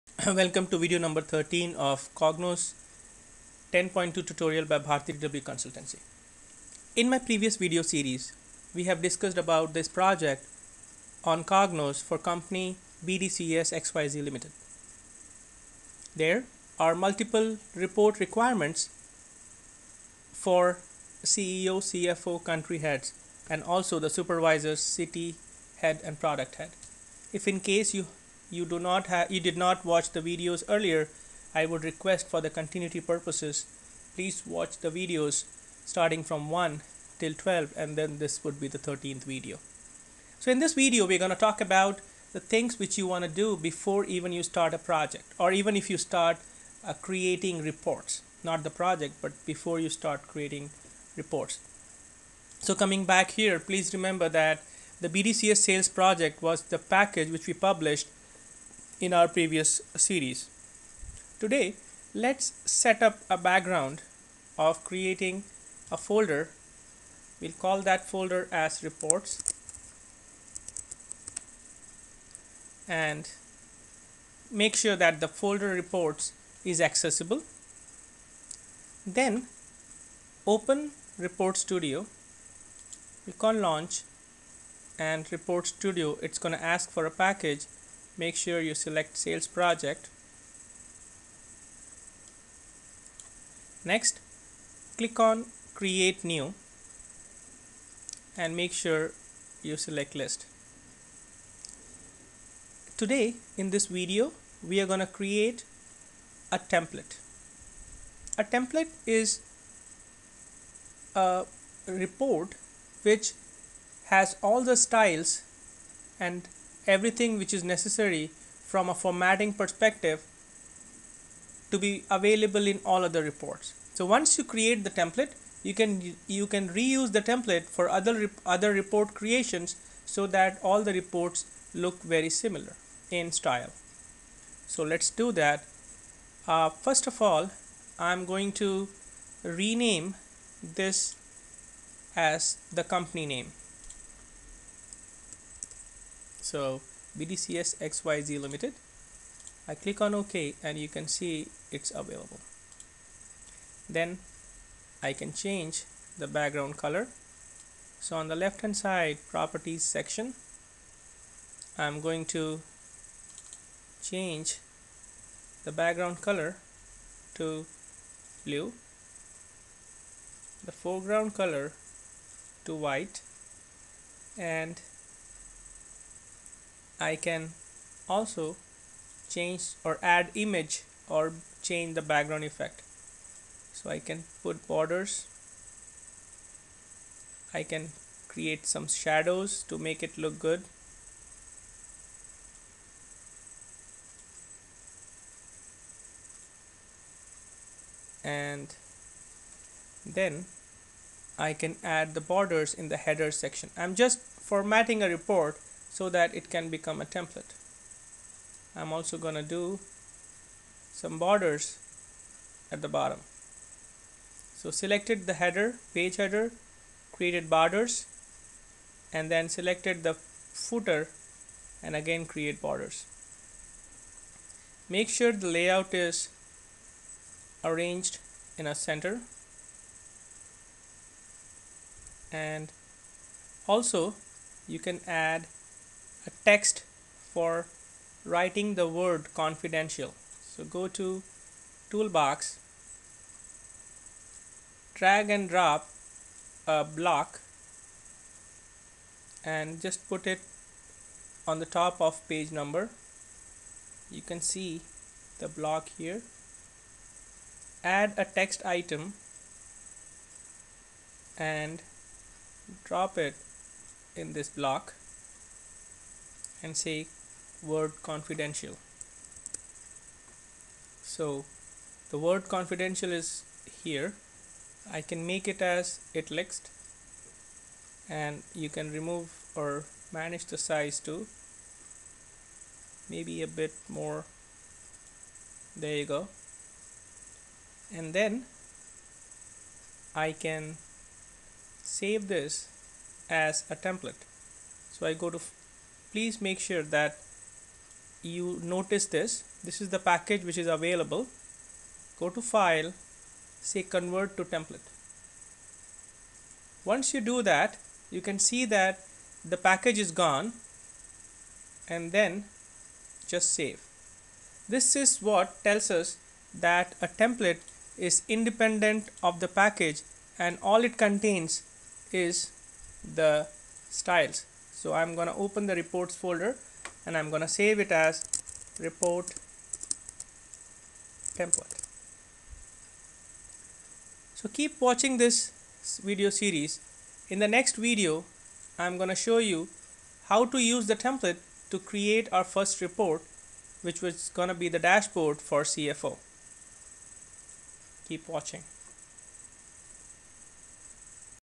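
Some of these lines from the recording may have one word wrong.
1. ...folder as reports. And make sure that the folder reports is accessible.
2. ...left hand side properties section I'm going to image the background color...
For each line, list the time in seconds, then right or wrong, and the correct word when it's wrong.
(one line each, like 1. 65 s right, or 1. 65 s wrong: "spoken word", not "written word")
1. 68 s right
2. 158 s wrong: "change", not "image".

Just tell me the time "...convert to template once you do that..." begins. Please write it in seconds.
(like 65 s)
303 s.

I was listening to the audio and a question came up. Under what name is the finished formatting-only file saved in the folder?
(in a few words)
report template.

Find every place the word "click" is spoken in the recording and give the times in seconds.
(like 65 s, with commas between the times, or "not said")
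83 s, 94 s, 149 s.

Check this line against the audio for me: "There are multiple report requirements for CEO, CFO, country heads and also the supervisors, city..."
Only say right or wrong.
right.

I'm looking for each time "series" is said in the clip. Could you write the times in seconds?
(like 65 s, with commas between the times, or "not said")
7 s, 59 s, 336 s.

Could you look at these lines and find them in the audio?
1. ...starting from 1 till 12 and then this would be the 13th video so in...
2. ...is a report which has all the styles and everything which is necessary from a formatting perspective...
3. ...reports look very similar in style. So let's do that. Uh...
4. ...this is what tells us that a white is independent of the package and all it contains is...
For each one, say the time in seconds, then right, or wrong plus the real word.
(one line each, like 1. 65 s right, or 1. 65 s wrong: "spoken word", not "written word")
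1. 35 s right
2. 109 s right
3. 130 s right
4. 314 s wrong: "template", not "white".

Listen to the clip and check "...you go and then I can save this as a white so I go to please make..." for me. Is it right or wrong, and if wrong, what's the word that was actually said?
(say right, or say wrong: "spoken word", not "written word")
wrong: "template", not "white".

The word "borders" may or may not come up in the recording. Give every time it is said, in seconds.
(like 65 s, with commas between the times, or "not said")
184 s, 202 s, 211 s, 217 s, 222 s.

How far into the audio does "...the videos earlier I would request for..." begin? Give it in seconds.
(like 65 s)
30 s.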